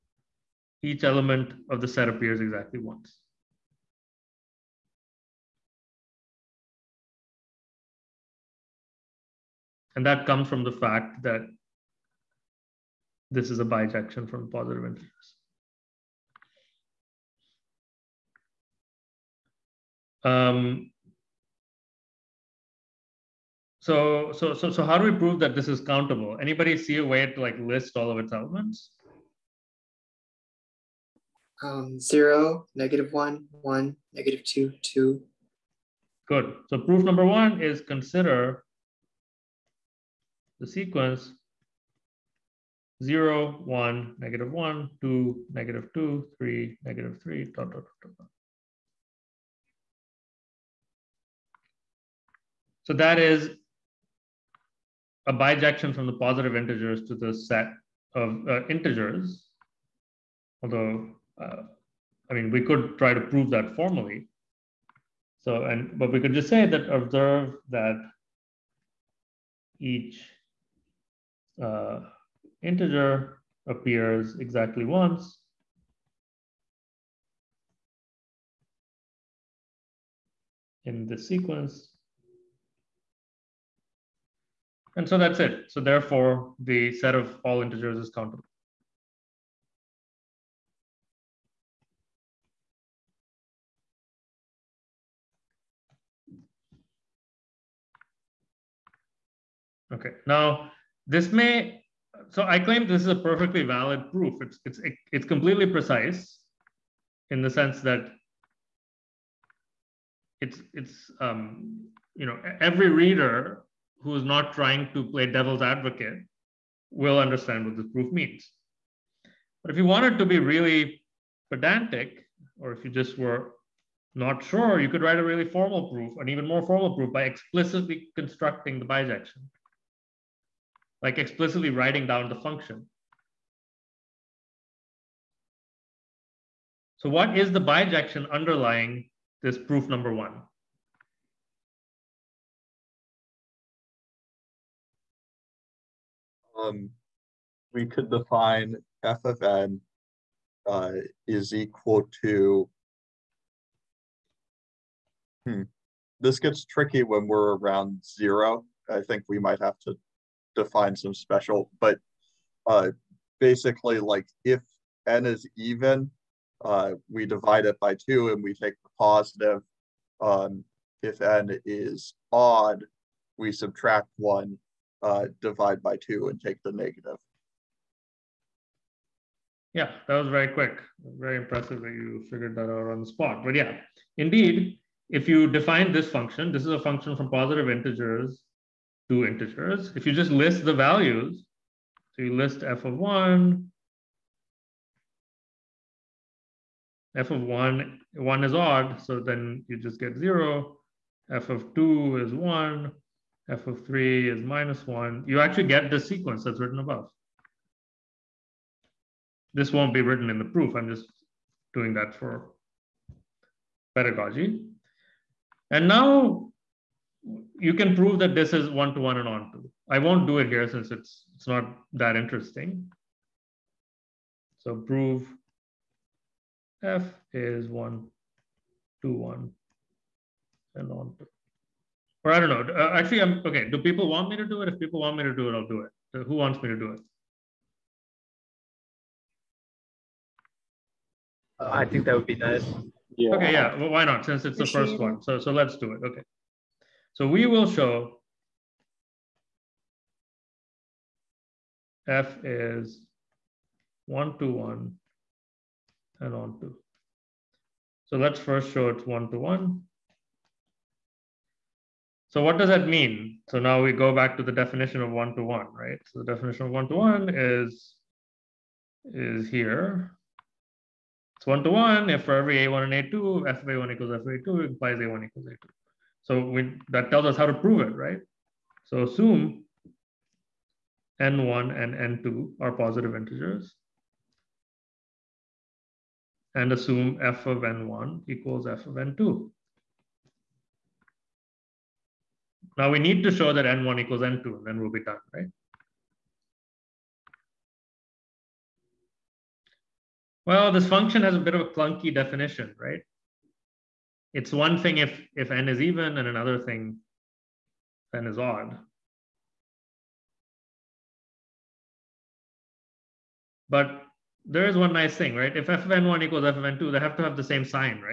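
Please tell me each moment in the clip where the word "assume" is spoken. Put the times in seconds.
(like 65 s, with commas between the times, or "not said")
279 s, 286 s.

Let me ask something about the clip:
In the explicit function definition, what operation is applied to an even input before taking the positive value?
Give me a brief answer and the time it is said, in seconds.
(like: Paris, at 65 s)
divide by two, at 167 s.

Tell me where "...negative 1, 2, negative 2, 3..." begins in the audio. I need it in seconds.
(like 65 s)
44 s.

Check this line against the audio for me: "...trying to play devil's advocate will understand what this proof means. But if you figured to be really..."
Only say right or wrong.
wrong.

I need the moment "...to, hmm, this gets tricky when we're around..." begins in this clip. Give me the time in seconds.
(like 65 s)
152 s.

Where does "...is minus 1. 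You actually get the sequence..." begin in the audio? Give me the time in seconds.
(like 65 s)
204 s.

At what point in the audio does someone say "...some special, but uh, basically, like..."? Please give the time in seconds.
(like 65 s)
160 s.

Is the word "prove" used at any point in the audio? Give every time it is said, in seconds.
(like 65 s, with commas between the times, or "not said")
25 s, 63 s, 217 s, 224 s, 277 s.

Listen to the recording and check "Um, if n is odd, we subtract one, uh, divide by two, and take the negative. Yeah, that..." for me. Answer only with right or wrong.
right.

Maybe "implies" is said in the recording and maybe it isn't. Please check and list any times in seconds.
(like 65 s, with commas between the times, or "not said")
274 s.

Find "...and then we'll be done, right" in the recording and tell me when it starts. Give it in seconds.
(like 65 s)
294 s.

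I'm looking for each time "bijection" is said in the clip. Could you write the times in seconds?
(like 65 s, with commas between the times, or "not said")
13 s, 55 s, 128 s, 137 s.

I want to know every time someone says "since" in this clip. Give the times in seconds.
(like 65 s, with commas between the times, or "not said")
220 s, 244 s.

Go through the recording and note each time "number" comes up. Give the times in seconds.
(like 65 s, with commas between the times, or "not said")
37 s, 139 s.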